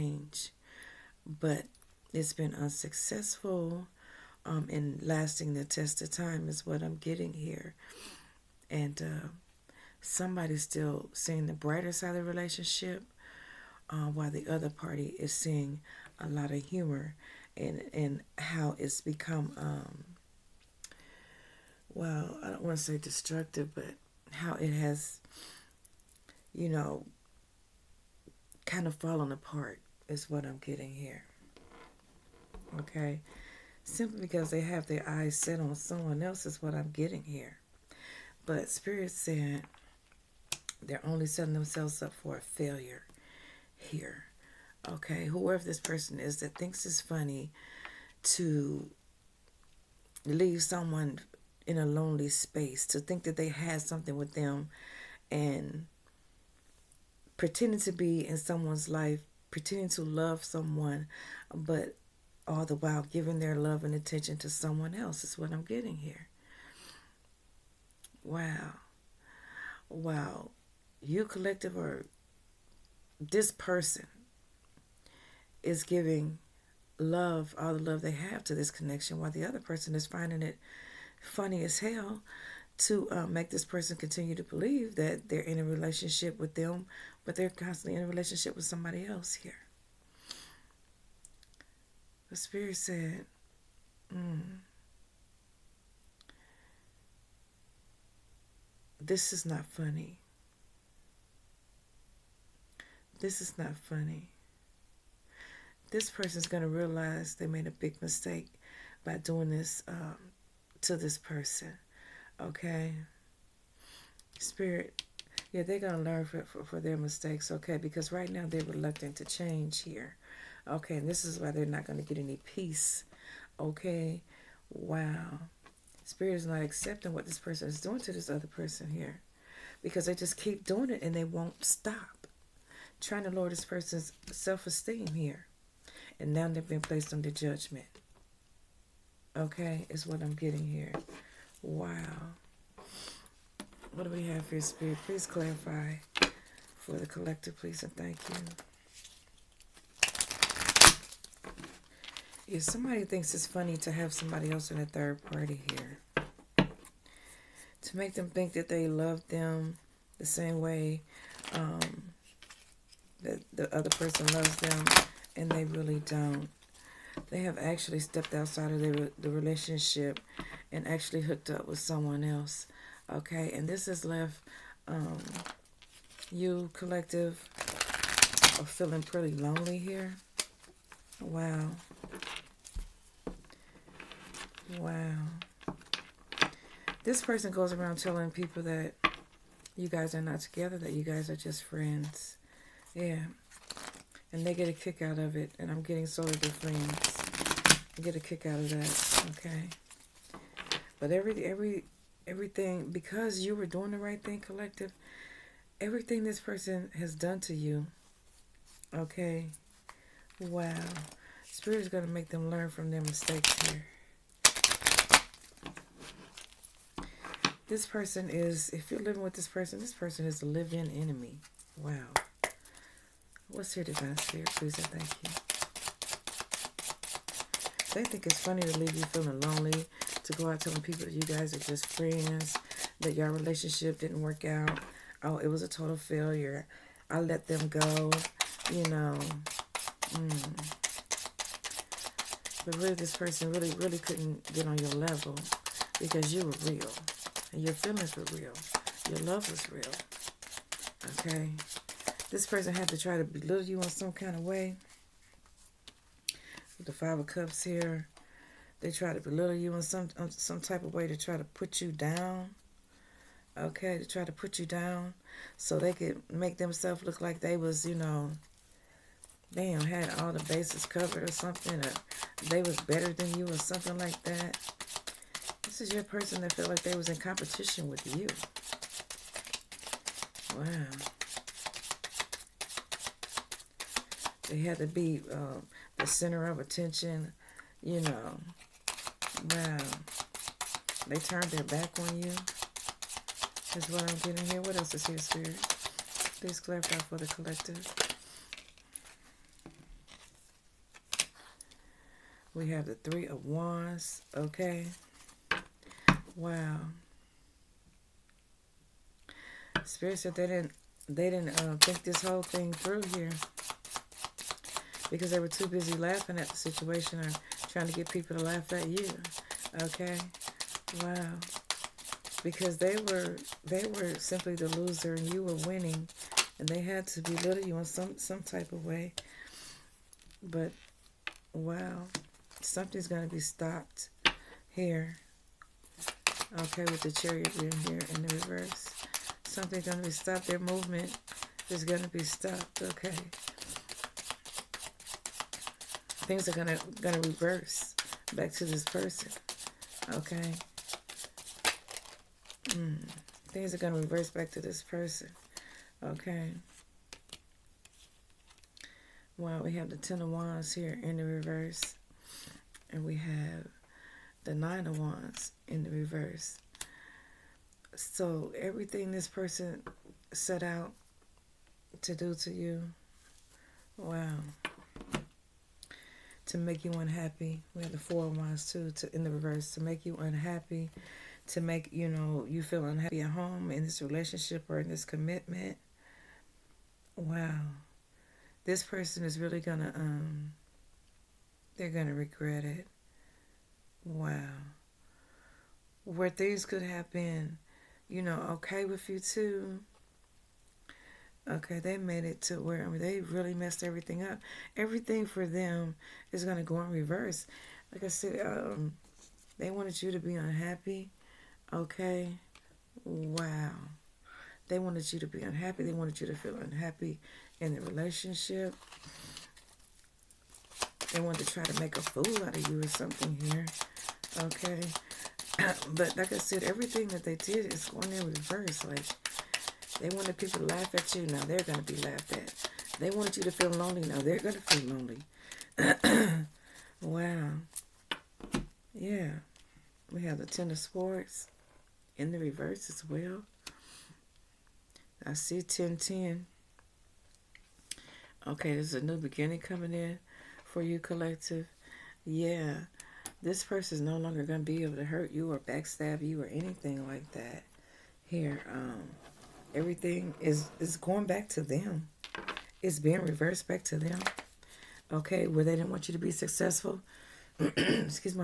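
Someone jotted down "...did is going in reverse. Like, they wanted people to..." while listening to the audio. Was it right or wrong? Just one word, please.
right.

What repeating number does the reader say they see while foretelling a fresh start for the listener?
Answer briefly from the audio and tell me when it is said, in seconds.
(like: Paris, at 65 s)
1010, at 445 s.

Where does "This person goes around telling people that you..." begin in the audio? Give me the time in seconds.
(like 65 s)
187 s.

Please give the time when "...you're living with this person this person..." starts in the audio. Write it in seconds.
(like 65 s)
218 s.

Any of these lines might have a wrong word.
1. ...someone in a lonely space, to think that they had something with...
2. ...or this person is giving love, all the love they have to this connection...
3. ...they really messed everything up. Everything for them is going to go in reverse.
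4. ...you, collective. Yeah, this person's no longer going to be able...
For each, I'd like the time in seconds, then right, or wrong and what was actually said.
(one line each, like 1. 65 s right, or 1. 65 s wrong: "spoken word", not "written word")
1. 50 s right
2. 71 s right
3. 402 s right
4. 450 s right.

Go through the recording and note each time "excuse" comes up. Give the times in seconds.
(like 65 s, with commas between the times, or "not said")
467 s.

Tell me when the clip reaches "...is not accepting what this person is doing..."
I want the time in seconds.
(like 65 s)
126 s.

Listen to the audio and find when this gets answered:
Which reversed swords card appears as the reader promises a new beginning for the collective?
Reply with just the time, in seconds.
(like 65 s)
440 s.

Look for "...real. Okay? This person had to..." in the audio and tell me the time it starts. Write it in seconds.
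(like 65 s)
249 s.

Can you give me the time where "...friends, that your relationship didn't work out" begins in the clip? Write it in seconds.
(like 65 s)
231 s.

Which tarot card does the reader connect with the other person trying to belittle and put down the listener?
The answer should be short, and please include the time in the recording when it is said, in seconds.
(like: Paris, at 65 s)
Five of Cups, at 256 s.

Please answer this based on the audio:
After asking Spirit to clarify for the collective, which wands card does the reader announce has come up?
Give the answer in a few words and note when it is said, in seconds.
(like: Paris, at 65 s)
Three of Wands, at 302 s.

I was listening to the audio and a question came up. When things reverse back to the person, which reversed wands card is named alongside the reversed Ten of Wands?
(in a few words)
Nine of Wands.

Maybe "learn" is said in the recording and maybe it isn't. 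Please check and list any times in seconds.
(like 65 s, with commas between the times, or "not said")
115 s, 212 s.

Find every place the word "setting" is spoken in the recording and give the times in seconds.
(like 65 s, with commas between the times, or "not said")
41 s.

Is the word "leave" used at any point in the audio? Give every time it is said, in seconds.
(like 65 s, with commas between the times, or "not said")
50 s, 228 s.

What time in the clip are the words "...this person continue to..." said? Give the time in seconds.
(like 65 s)
83 s.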